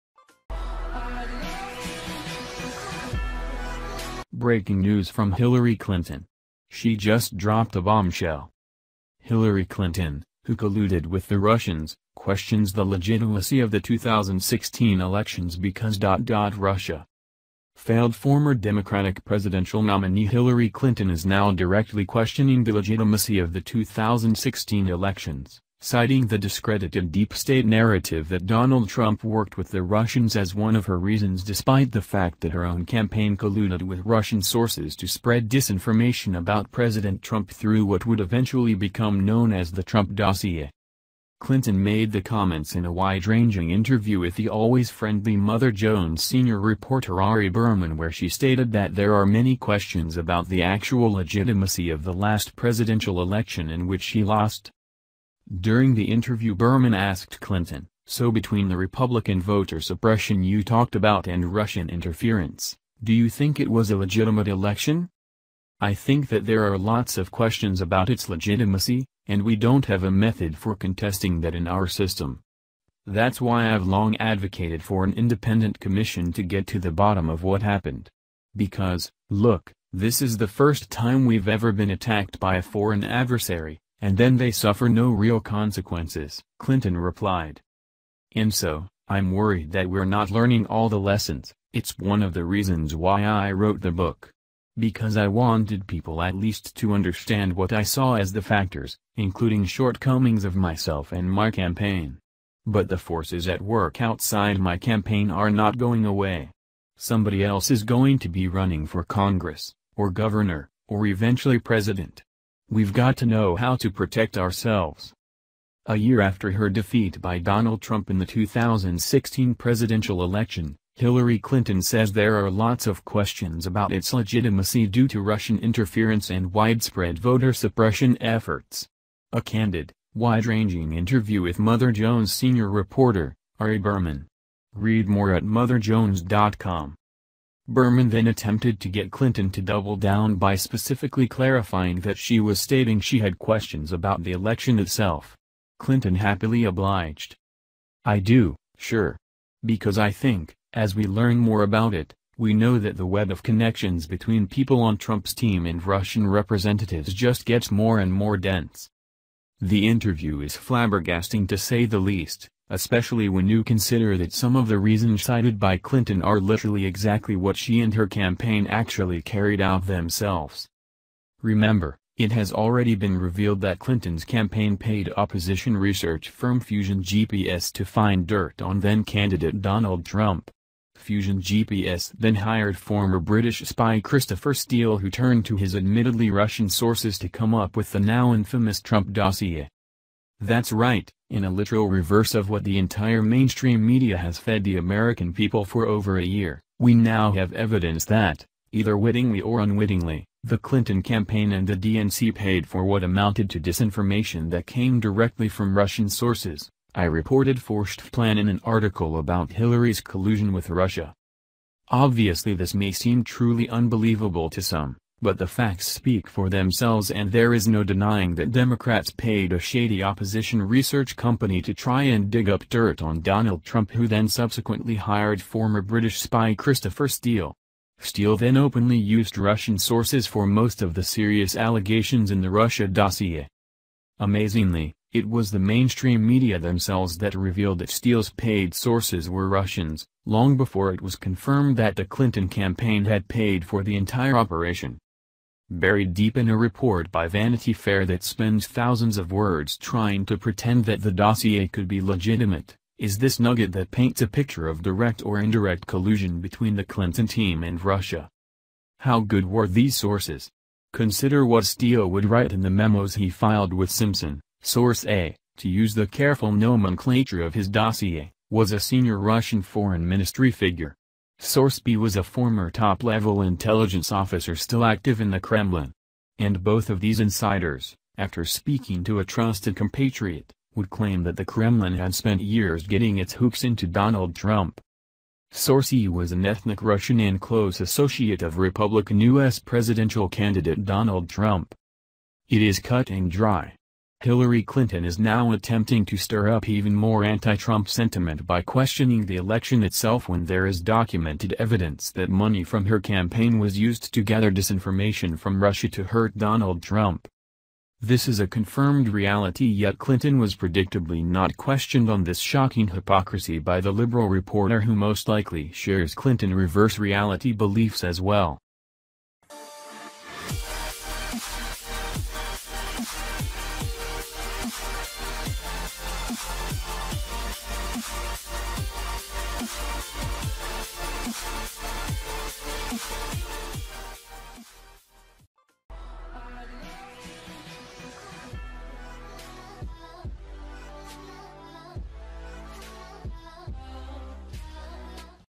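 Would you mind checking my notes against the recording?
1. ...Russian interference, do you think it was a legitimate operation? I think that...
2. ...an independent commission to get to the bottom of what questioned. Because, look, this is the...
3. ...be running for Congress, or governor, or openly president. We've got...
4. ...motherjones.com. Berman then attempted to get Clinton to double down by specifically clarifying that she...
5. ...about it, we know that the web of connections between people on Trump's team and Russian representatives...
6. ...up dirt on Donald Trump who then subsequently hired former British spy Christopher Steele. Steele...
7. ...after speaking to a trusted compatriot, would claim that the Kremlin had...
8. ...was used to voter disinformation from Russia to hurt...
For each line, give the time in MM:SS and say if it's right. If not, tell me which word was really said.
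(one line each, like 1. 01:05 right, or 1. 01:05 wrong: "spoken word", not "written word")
1. 01:01 wrong: "election", not "operation"
2. 01:15 wrong: "happened", not "questioned"
3. 01:48 wrong: "eventually", not "openly"
4. 02:15 right
5. 02:31 right
6. 03:42 right
7. 04:38 right
8. 05:03 wrong: "gather", not "voter".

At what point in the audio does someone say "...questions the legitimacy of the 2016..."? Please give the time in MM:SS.
00:12.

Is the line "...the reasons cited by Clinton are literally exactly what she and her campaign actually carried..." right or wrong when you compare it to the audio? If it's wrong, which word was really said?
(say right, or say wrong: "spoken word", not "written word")
right.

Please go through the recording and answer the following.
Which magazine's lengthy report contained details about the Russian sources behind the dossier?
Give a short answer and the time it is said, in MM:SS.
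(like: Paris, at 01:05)
Vanity Fair, at 04:07.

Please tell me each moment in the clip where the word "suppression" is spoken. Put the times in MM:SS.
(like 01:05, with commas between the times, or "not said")
00:59, 02:07.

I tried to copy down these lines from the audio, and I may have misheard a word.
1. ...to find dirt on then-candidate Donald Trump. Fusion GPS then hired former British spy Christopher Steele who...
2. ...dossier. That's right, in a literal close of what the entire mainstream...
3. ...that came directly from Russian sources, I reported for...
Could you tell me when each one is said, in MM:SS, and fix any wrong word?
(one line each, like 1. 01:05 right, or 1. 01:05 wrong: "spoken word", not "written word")
1. 02:57 right
2. 03:09 wrong: "reverse", not "close"
3. 03:24 right.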